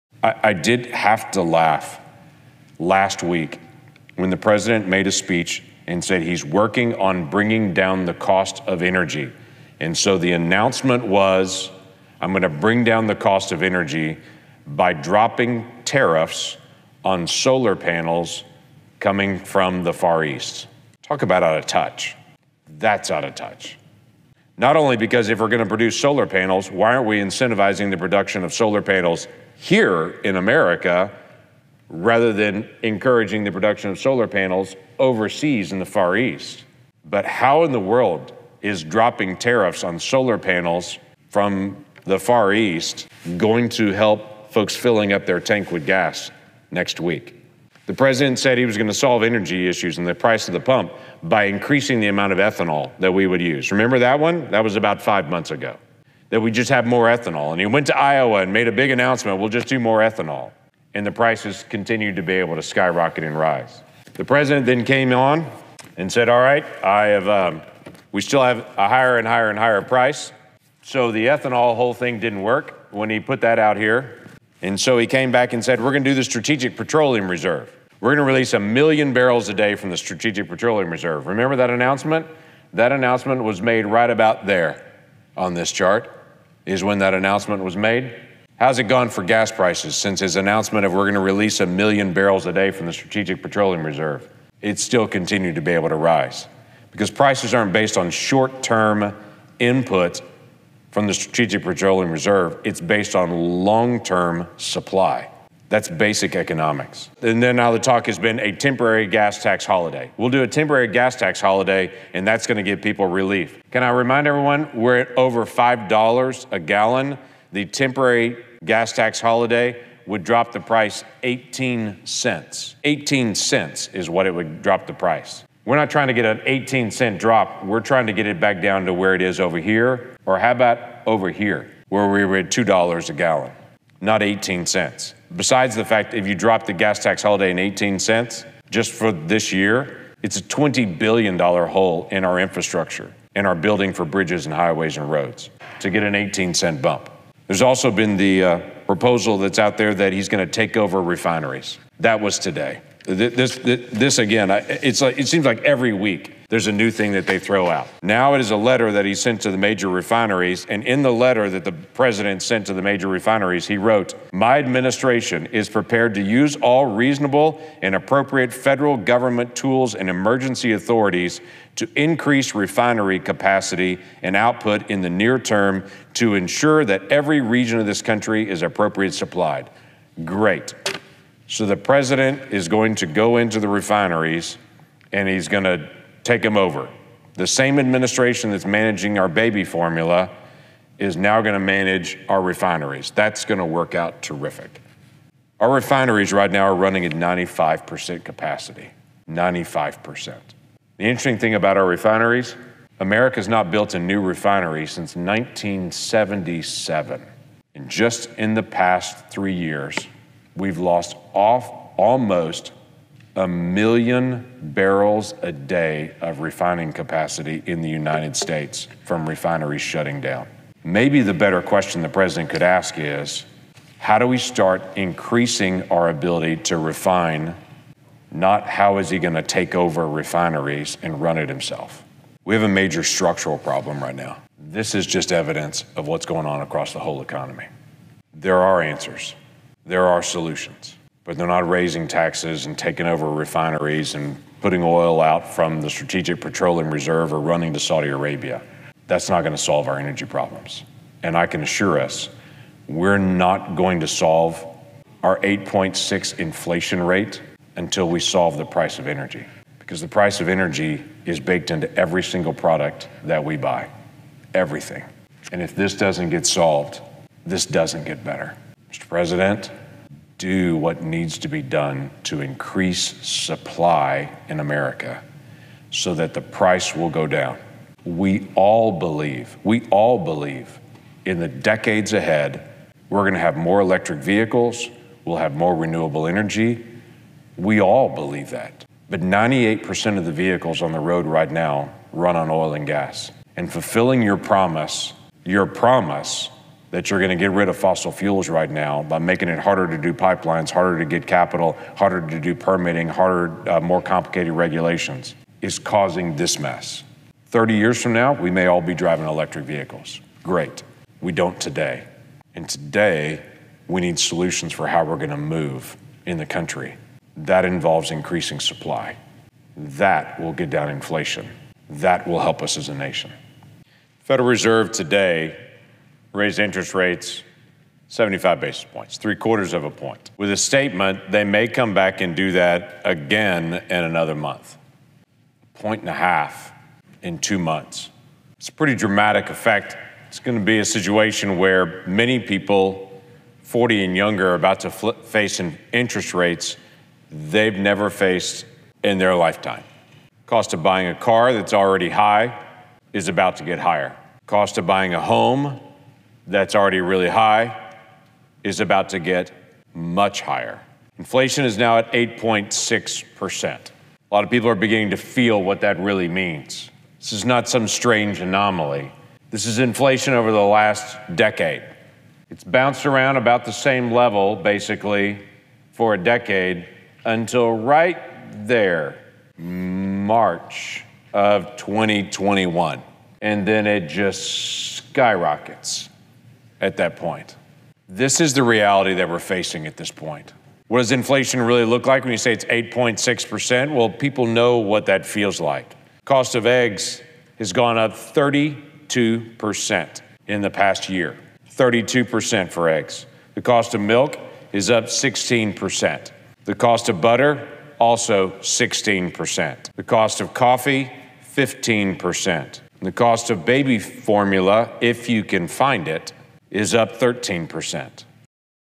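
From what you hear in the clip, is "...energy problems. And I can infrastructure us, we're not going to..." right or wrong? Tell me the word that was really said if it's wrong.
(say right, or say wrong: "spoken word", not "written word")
wrong: "assure", not "infrastructure".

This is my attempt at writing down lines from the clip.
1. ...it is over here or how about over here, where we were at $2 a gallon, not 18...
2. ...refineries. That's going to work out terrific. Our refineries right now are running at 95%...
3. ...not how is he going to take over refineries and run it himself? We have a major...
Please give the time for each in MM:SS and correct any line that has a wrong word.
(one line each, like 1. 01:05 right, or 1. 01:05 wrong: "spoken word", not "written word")
1. 02:09 right
2. 03:12 right
3. 03:48 right.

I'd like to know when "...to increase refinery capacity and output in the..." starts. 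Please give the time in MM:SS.
02:51.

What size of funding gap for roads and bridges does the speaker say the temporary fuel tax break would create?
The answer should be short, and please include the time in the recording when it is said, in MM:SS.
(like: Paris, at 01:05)
$20 billion, at 02:20.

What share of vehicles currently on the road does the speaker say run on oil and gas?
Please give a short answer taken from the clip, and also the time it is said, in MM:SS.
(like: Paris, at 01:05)
98%, at 04:49.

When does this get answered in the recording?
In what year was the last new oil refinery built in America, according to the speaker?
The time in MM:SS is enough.
03:25.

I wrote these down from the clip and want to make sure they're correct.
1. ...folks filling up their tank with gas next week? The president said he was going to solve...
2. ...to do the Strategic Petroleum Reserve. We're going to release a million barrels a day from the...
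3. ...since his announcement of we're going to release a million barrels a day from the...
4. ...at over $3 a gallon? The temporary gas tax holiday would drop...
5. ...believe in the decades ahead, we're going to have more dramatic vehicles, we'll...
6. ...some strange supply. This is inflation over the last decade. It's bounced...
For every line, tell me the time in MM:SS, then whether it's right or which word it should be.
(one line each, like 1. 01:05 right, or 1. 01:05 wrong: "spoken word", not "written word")
1. 00:44 right
2. 01:16 right
3. 01:29 right
4. 01:54 wrong: "5", not "3"
5. 04:40 wrong: "electric", not "dramatic"
6. 06:07 wrong: "anomaly", not "supply".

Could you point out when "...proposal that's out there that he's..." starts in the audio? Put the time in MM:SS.
02:28.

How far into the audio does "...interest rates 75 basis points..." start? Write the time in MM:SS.
05:26.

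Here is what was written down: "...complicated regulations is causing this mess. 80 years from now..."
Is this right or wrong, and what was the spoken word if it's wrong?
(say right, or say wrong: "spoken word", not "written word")
wrong: "30", not "80".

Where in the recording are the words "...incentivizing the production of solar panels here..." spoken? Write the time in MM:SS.
00:27.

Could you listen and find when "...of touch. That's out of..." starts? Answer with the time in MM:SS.
00:21.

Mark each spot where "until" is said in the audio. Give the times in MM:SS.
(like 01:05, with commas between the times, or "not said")
04:17, 06:17.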